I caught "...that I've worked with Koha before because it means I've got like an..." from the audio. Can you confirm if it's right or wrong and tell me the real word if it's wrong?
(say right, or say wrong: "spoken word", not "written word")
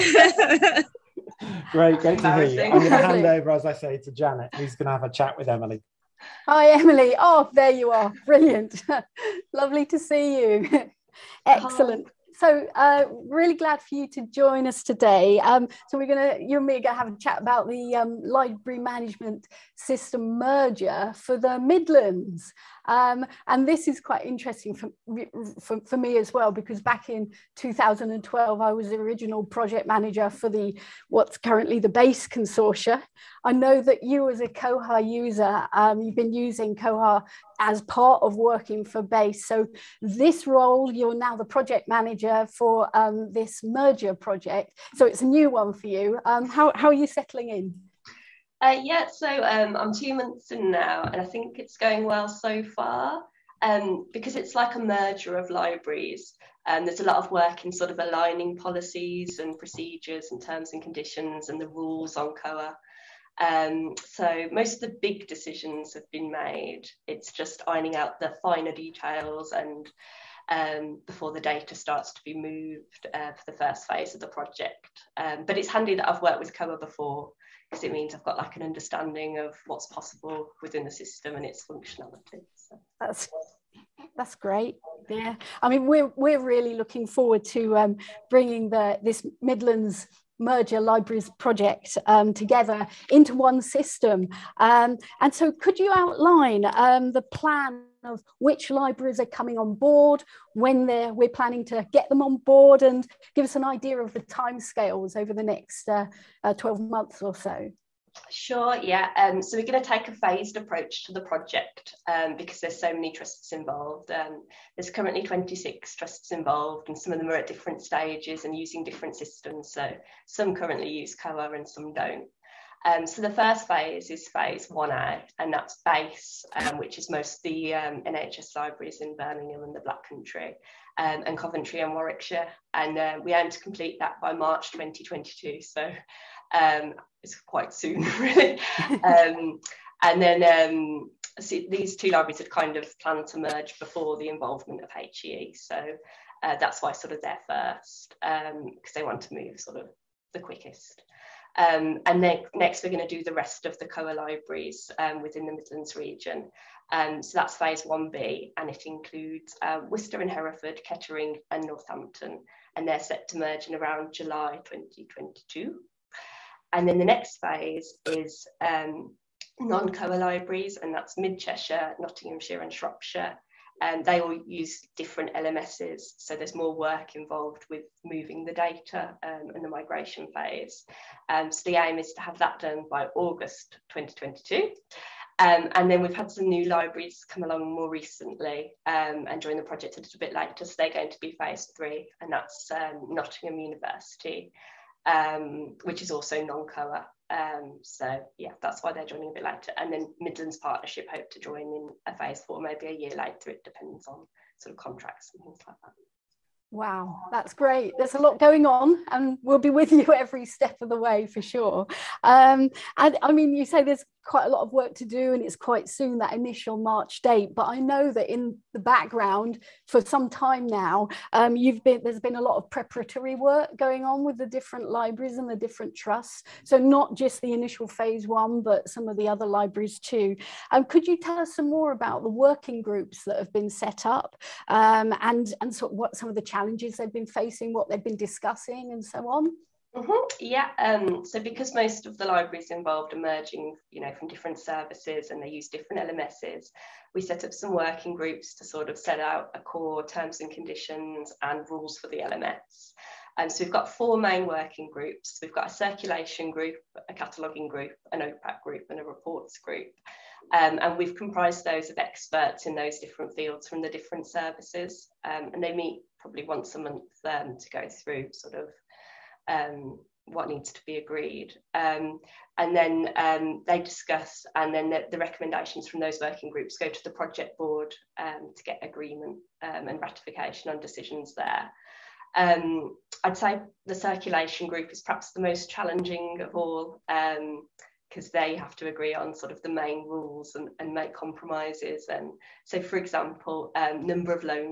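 right.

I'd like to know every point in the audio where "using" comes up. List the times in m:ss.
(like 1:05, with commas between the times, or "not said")
0:36, 1:58.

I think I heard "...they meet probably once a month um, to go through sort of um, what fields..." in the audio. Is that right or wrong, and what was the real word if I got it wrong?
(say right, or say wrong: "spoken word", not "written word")
wrong: "needs", not "fields".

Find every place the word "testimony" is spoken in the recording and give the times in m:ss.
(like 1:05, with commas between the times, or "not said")
not said.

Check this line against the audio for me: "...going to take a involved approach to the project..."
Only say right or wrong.
wrong.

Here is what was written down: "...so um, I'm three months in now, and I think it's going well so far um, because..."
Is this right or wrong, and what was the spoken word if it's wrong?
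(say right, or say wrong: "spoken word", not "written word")
wrong: "two", not "three".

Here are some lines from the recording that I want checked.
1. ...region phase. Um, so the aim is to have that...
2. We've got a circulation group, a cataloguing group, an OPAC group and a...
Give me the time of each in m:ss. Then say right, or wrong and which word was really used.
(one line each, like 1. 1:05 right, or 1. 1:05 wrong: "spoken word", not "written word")
1. 2:59 wrong: "migration", not "region"
2. 4:15 right.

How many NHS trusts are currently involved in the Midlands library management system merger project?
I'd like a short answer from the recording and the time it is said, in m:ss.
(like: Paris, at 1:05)
26, at 1:55.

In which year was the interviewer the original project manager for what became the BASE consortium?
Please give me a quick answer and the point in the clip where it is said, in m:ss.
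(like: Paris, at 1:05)
2012, at 0:27.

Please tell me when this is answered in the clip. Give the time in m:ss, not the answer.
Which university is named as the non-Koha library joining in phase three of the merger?
3:13.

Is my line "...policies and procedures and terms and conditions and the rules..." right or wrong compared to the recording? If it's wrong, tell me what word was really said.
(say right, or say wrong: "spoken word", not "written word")
right.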